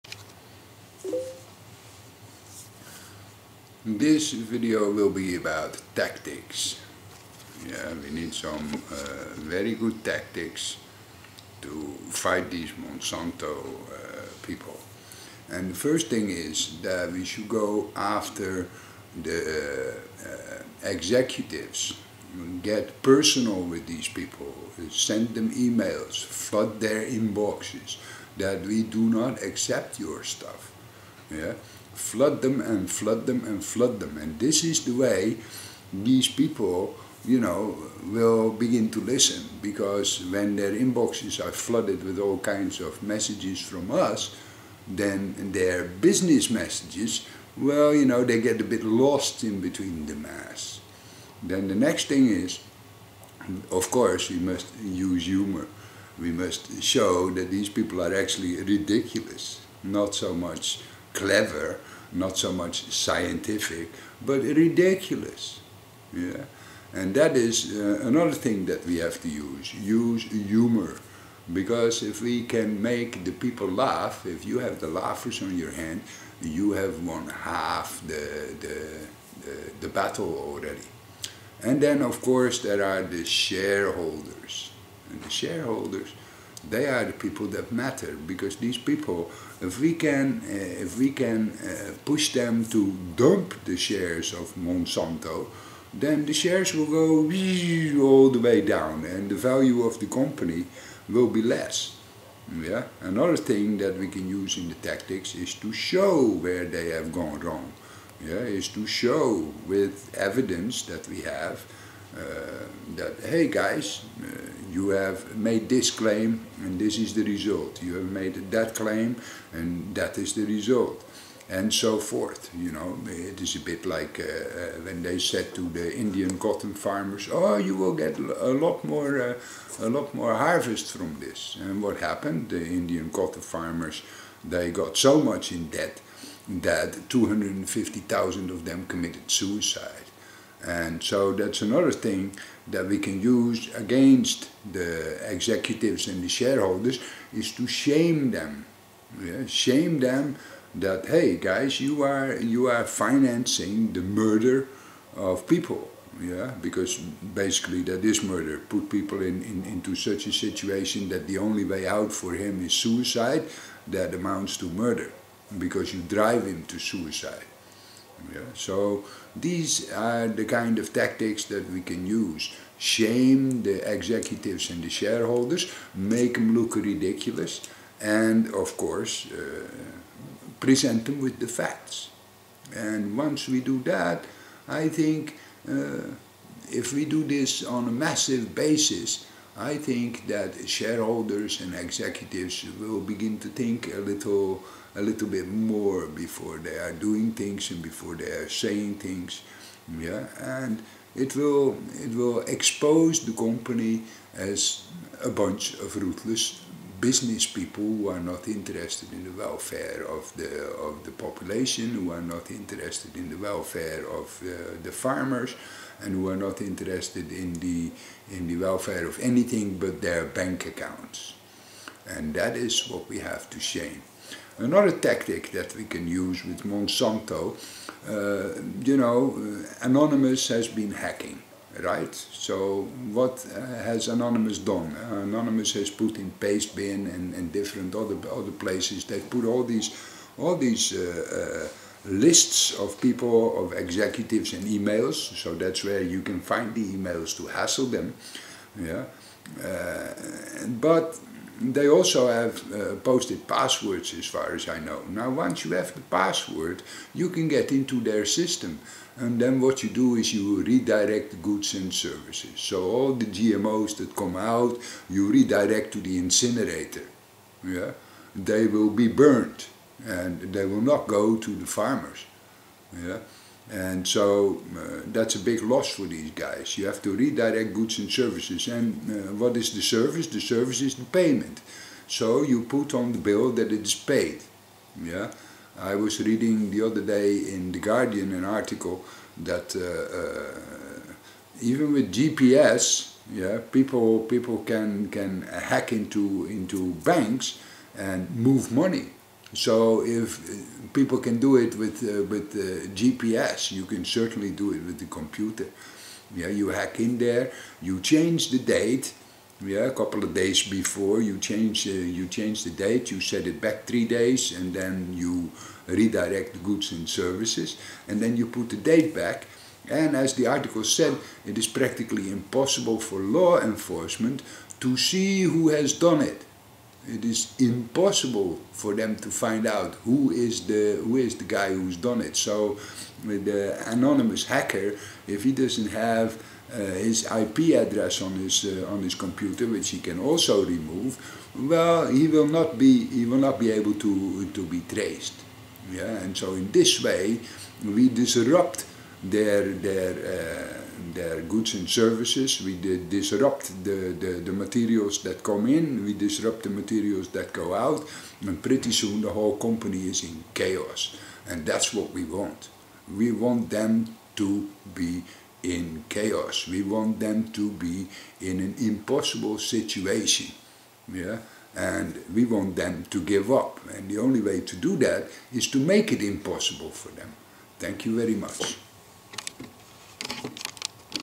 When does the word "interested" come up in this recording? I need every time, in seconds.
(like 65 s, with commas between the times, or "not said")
208 s, 212 s, 216 s.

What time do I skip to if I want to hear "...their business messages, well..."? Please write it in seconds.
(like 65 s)
45 s.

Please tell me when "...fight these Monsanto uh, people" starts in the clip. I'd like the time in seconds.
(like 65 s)
12 s.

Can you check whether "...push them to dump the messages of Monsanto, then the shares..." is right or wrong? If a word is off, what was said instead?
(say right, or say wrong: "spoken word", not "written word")
wrong: "shares", not "messages".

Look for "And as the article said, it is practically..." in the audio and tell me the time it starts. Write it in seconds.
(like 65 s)
319 s.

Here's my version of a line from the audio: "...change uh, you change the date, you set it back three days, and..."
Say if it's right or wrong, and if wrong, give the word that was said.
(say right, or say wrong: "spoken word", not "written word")
right.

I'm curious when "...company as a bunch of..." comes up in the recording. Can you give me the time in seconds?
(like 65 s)
203 s.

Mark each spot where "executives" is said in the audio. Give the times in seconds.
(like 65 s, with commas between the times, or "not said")
20 s, 145 s, 173 s, 191 s, 243 s.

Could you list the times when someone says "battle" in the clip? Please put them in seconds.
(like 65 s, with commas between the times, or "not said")
79 s.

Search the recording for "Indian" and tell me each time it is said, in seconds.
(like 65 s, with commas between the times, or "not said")
126 s, 132 s.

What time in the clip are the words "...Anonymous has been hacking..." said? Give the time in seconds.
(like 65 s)
229 s.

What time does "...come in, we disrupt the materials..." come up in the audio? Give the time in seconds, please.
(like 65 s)
355 s.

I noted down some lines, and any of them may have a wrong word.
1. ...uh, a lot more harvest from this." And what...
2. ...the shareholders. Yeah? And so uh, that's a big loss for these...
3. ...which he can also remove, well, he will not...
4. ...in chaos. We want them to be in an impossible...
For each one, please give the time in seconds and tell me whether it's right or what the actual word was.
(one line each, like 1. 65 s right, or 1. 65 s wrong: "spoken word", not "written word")
1. 129 s right
2. 271 s wrong: "farmers", not "shareholders"
3. 339 s right
4. 365 s right.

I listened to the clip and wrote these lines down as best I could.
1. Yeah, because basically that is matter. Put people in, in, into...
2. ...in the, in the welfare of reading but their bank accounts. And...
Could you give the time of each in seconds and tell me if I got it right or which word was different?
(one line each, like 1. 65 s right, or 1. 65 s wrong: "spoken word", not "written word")
1. 156 s wrong: "murder", not "matter"
2. 217 s wrong: "anything", not "reading".